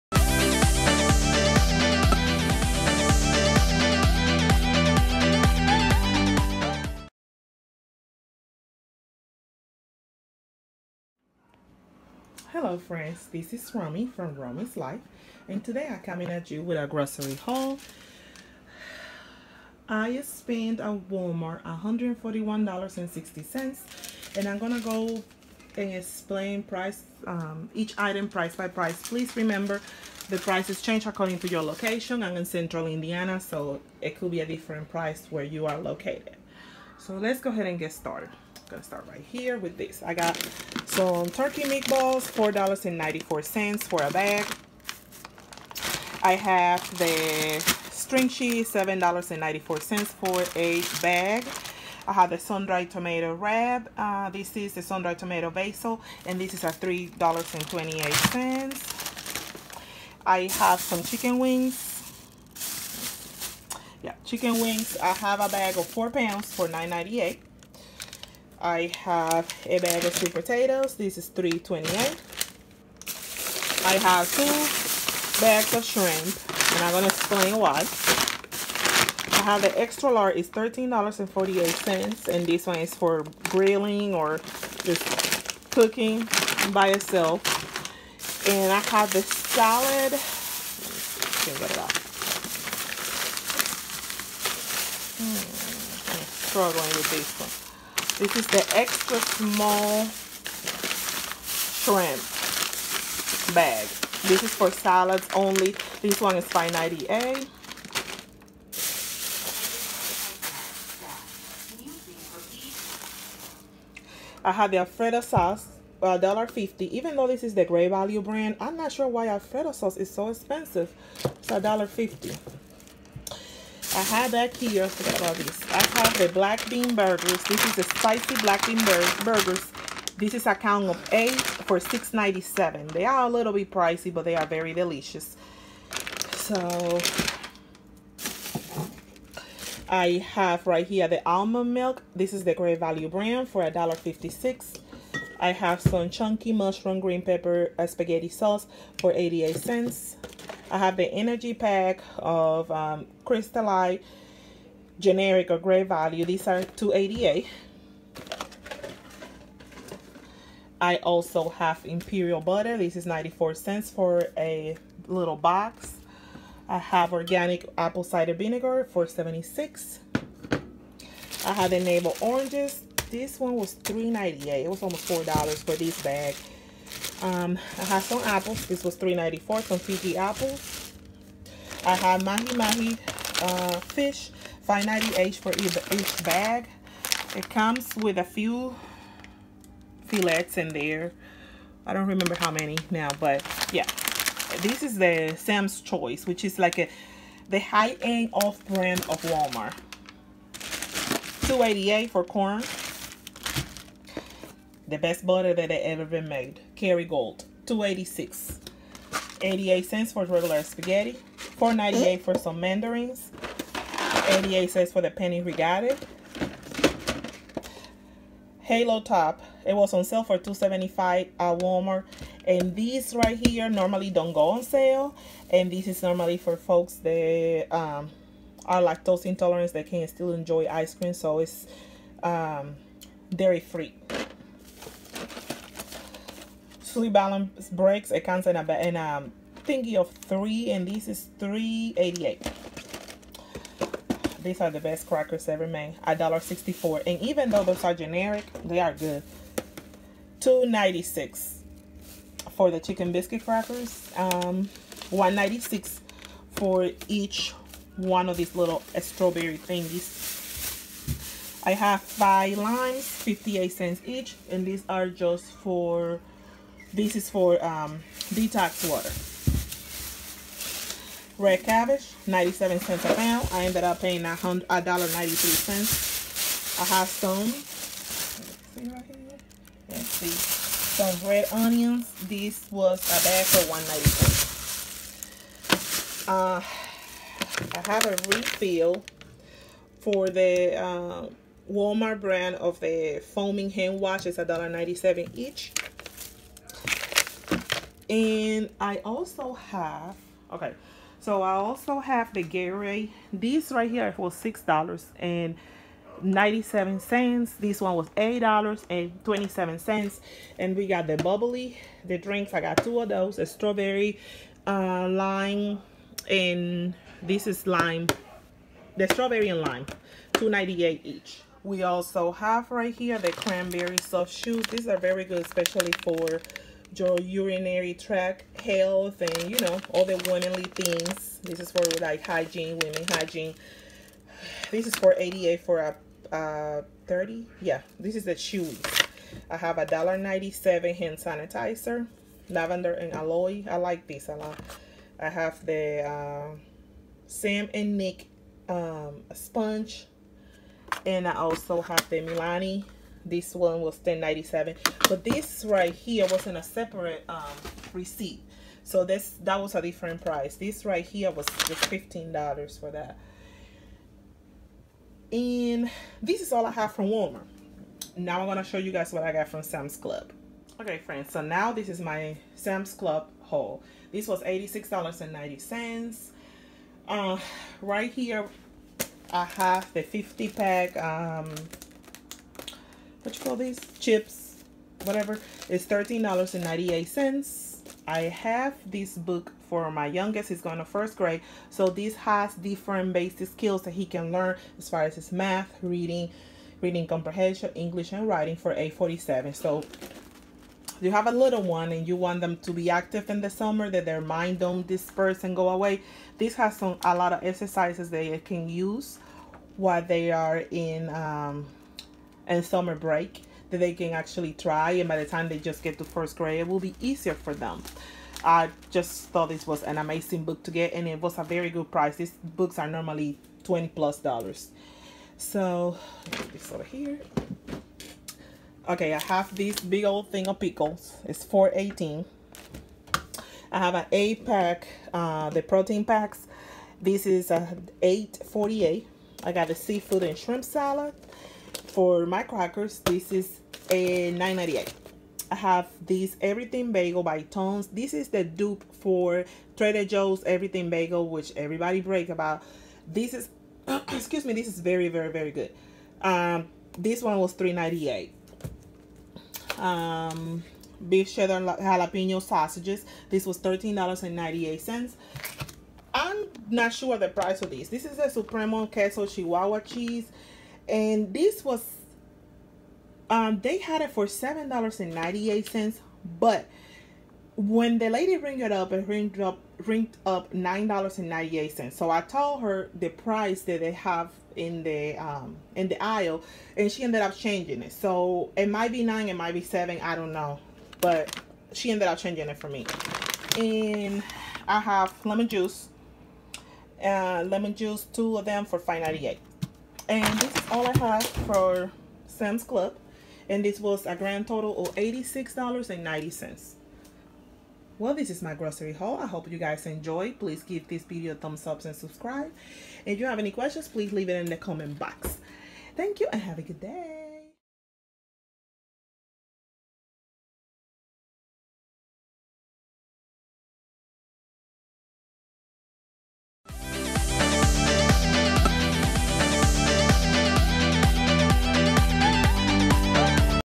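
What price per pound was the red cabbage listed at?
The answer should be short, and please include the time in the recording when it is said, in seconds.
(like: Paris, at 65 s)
97 cents, at 272 s.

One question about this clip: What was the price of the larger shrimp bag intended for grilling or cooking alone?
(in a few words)
$13.48.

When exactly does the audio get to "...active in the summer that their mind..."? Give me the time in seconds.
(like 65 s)
402 s.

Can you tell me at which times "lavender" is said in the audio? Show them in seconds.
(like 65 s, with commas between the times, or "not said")
342 s.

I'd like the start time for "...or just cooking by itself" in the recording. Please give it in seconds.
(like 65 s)
84 s.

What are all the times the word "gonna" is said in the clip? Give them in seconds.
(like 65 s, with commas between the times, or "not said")
24 s, 38 s, 76 s.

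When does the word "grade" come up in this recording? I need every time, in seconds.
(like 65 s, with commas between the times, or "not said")
391 s, 416 s.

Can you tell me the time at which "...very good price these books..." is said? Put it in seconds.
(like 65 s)
421 s.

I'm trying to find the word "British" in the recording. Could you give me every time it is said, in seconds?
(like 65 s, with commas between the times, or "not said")
not said.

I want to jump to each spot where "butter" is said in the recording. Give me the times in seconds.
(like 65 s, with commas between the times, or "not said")
162 s, 205 s.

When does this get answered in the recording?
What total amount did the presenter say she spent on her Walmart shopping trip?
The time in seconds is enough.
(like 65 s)
21 s.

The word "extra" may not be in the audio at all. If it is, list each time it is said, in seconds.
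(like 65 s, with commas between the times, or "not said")
79 s, 98 s.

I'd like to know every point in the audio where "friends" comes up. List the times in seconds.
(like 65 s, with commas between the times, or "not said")
12 s, 371 s.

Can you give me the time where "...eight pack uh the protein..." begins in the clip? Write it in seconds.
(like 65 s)
434 s.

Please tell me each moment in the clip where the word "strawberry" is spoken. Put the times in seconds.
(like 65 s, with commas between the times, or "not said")
258 s, 313 s, 319 s.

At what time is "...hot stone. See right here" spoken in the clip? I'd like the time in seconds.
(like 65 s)
276 s.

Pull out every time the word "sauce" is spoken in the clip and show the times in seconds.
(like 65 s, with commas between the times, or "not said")
115 s, 119 s, 148 s.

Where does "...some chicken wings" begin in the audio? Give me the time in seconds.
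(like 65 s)
60 s.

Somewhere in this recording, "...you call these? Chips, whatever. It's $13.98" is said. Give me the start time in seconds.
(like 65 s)
383 s.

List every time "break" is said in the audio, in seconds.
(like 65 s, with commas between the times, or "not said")
237 s, 412 s, 451 s.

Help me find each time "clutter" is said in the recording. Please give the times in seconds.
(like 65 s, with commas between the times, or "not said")
not said.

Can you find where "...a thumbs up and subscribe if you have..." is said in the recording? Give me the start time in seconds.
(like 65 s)
511 s.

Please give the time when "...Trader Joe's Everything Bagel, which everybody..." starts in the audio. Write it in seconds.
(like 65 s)
449 s.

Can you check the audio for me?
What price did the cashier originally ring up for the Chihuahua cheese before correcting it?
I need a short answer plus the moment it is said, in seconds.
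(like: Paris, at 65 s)
$9.98, at 480 s.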